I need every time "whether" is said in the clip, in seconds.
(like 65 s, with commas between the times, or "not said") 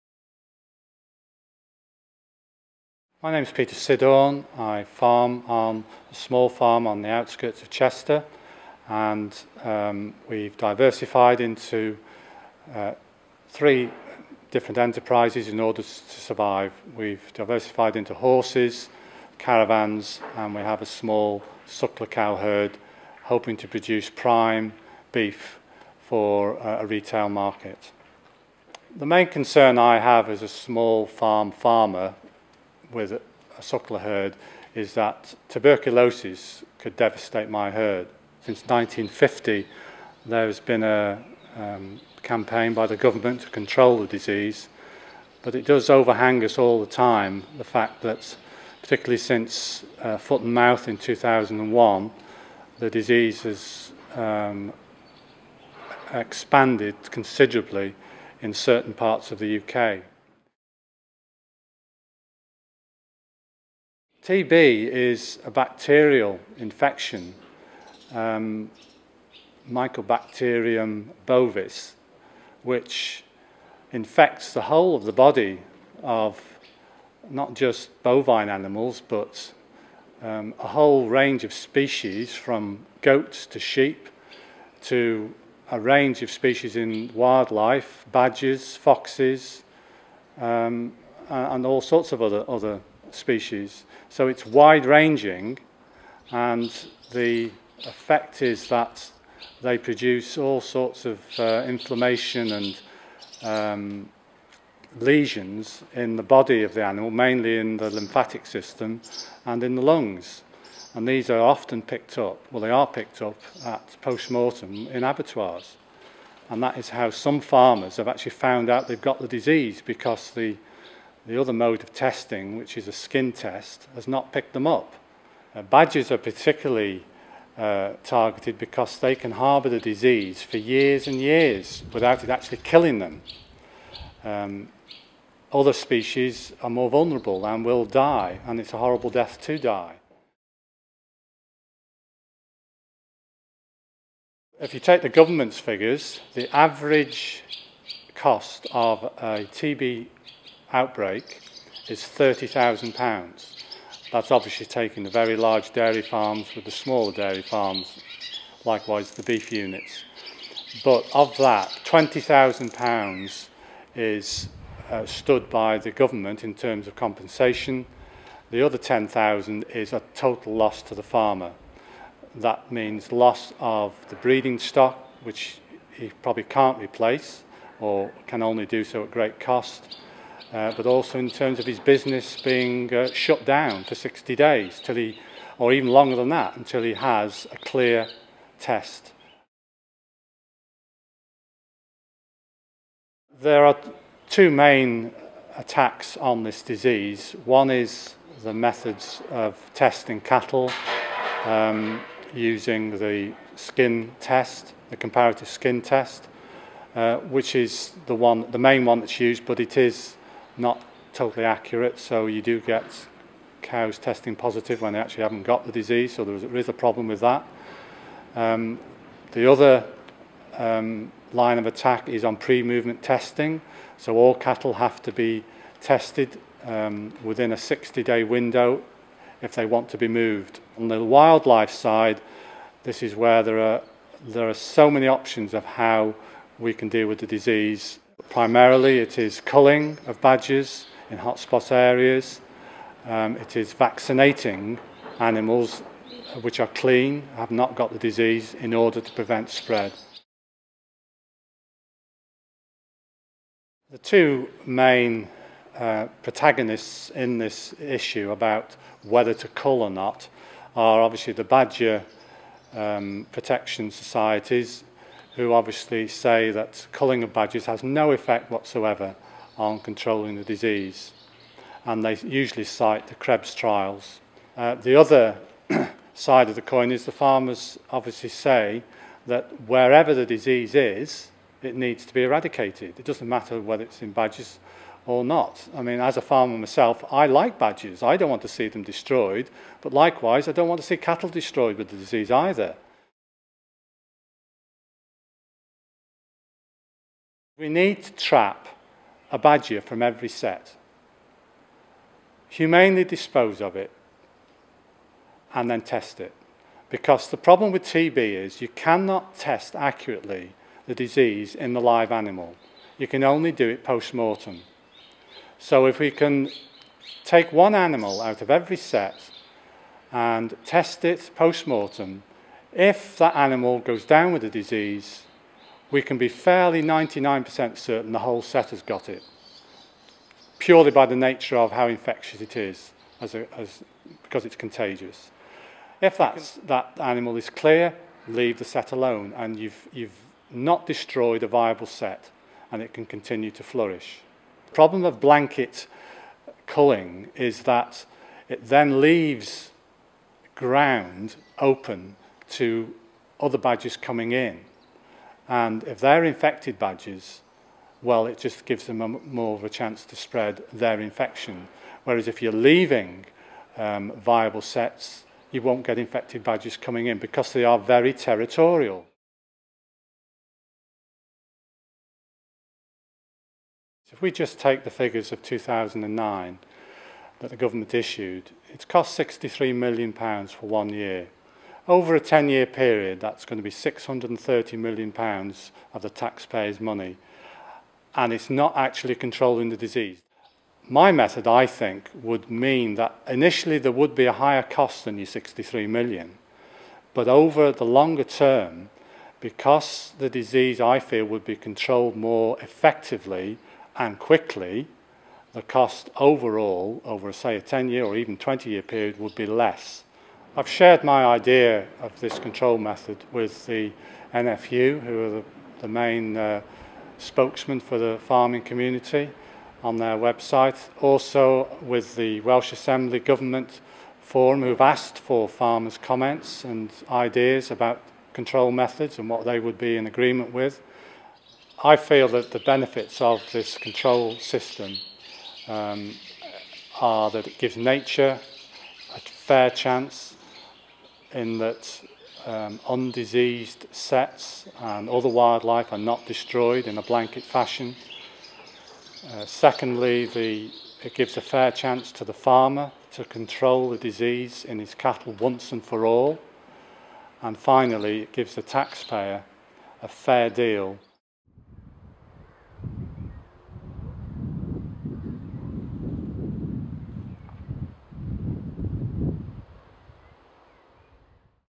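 259 s, 283 s.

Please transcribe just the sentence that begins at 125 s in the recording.
Uh, badgers are particularly uh, targeted because they can harbour the disease for years and years without it actually killing them.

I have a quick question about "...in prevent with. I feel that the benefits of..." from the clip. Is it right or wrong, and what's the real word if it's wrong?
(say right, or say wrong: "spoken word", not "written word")
wrong: "agreement", not "prevent".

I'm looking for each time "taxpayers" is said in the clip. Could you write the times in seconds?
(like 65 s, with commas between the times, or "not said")
386 s, 458 s.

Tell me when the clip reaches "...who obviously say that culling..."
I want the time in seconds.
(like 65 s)
265 s.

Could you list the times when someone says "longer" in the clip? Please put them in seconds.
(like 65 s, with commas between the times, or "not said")
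185 s, 397 s.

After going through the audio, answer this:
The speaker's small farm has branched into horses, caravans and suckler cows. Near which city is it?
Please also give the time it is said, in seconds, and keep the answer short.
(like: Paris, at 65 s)
Chester, at 7 s.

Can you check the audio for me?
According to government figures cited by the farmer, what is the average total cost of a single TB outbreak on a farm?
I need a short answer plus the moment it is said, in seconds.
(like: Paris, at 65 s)
£30,000, at 152 s.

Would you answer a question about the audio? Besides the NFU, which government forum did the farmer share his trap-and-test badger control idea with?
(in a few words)
Welsh Assembly Government Forum.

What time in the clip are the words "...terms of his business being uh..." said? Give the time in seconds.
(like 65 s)
181 s.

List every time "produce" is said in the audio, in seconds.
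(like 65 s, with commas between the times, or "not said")
23 s, 99 s.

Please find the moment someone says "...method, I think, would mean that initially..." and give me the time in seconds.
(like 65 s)
391 s.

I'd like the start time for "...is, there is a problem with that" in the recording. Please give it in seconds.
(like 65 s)
216 s.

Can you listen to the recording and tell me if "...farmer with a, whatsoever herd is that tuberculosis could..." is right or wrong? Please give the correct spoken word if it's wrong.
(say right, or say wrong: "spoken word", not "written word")
wrong: "suckler", not "whatsoever".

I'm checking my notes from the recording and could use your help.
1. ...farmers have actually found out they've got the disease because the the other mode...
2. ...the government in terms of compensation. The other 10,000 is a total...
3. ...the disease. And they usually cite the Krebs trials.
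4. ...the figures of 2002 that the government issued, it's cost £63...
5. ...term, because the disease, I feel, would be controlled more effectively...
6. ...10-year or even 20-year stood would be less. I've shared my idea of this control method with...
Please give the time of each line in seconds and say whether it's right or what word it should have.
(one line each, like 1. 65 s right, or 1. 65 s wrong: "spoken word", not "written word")
1. 117 s right
2. 165 s right
3. 270 s right
4. 374 s wrong: "2009", not "2002"
5. 398 s right
6. 407 s wrong: "period", not "stood".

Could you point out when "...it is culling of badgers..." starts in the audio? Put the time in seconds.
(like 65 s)
238 s.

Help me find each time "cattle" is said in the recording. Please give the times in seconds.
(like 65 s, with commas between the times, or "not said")
200 s, 224 s, 290 s, 454 s.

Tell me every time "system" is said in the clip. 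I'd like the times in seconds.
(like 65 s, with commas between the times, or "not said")
108 s, 434 s.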